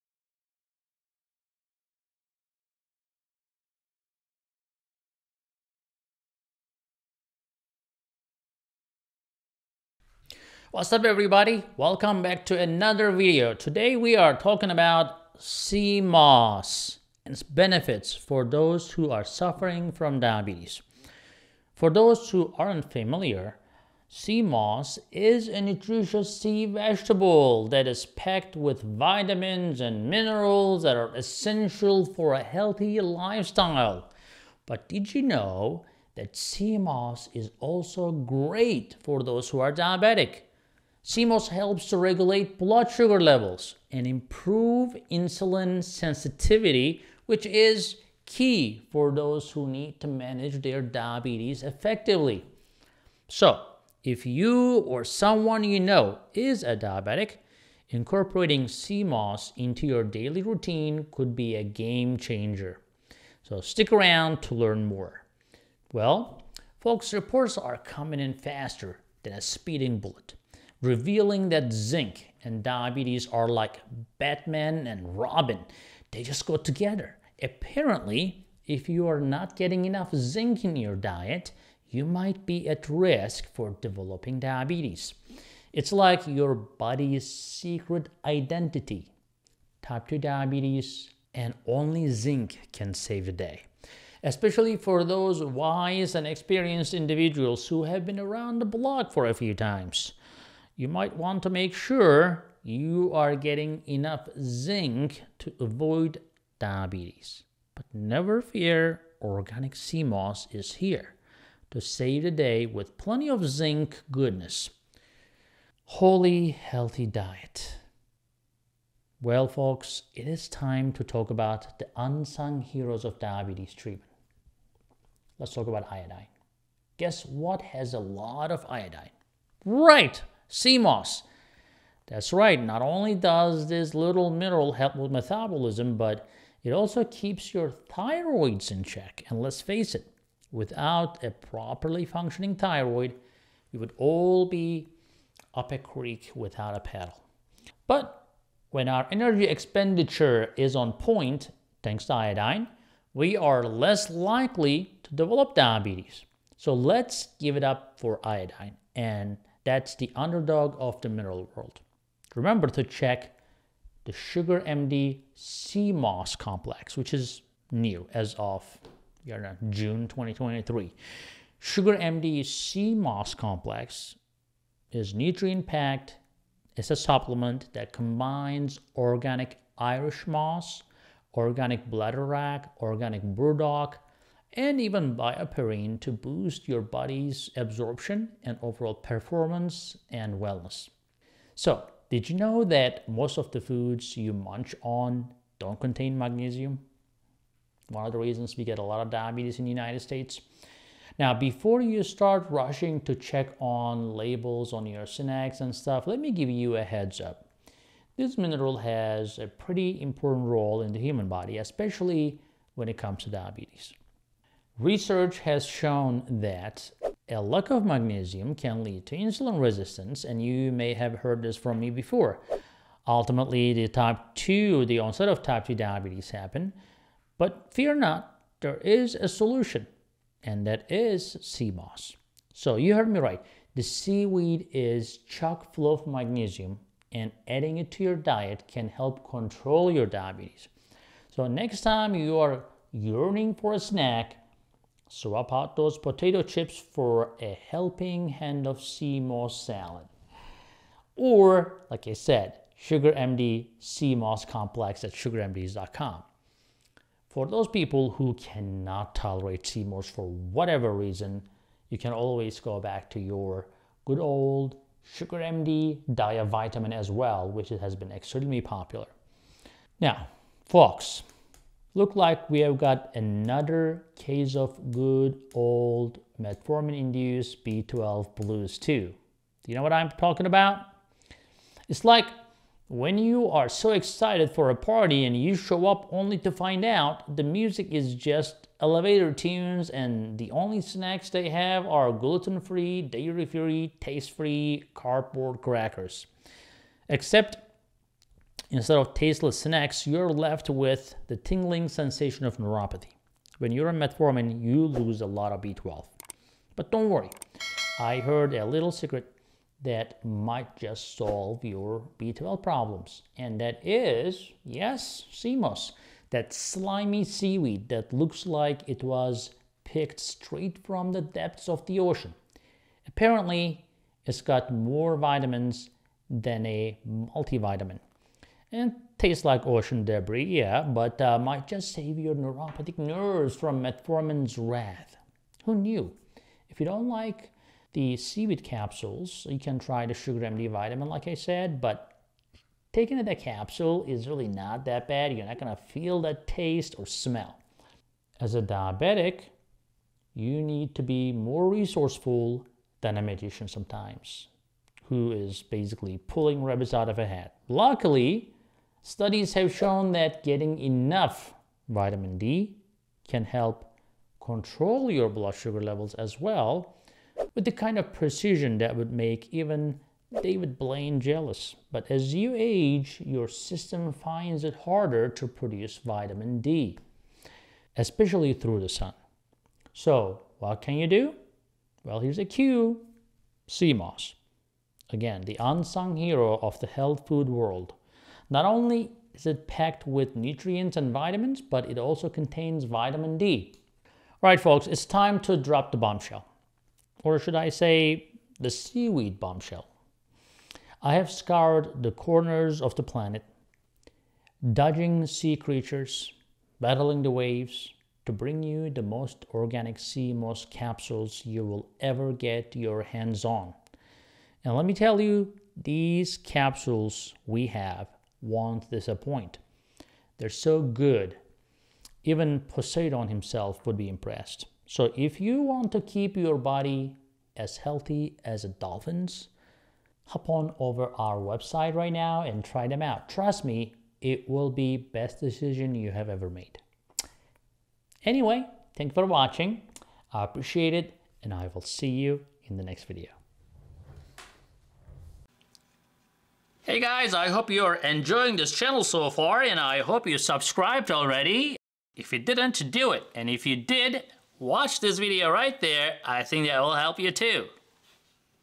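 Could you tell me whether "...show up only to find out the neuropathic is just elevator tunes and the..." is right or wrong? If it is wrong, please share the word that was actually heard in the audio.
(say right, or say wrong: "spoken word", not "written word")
wrong: "music", not "neuropathic".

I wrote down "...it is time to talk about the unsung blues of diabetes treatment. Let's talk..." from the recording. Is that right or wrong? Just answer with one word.
wrong.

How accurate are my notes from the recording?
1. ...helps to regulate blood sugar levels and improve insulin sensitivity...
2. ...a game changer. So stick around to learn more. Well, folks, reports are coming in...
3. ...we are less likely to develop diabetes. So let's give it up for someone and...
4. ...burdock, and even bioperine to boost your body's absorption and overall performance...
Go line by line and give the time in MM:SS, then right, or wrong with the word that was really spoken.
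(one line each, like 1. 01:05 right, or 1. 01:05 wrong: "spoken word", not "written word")
1. 00:41 right
2. 01:01 right
3. 02:33 wrong: "iodine", not "someone"
4. 03:03 right.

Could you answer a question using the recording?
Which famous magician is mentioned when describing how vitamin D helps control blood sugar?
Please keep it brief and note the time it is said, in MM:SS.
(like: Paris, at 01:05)
David Blaine, at 06:10.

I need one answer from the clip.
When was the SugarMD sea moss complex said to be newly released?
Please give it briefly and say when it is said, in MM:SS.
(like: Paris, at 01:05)
June 2023, at 02:49.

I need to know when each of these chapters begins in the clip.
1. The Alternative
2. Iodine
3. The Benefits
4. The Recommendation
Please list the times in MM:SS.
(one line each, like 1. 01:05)
1. 04:16
2. 01:57
3. 00:40
4. 02:42.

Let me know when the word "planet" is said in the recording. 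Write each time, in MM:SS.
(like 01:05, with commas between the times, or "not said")
06:43.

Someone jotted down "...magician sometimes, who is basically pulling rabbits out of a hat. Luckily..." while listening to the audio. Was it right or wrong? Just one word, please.
right.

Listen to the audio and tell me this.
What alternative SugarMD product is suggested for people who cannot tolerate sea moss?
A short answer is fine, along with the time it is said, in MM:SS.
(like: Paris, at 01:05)
SugarMD Dia Vitamin, at 04:25.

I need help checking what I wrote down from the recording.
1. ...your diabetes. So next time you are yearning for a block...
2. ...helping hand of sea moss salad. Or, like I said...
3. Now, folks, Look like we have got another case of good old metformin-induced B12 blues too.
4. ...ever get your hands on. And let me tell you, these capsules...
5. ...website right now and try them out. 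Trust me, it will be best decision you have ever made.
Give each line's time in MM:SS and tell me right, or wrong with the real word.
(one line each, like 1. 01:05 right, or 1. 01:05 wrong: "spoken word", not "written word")
1. 03:59 wrong: "snack", not "block"
2. 04:07 right
3. 04:29 right
4. 06:52 right
5. 07:11 right.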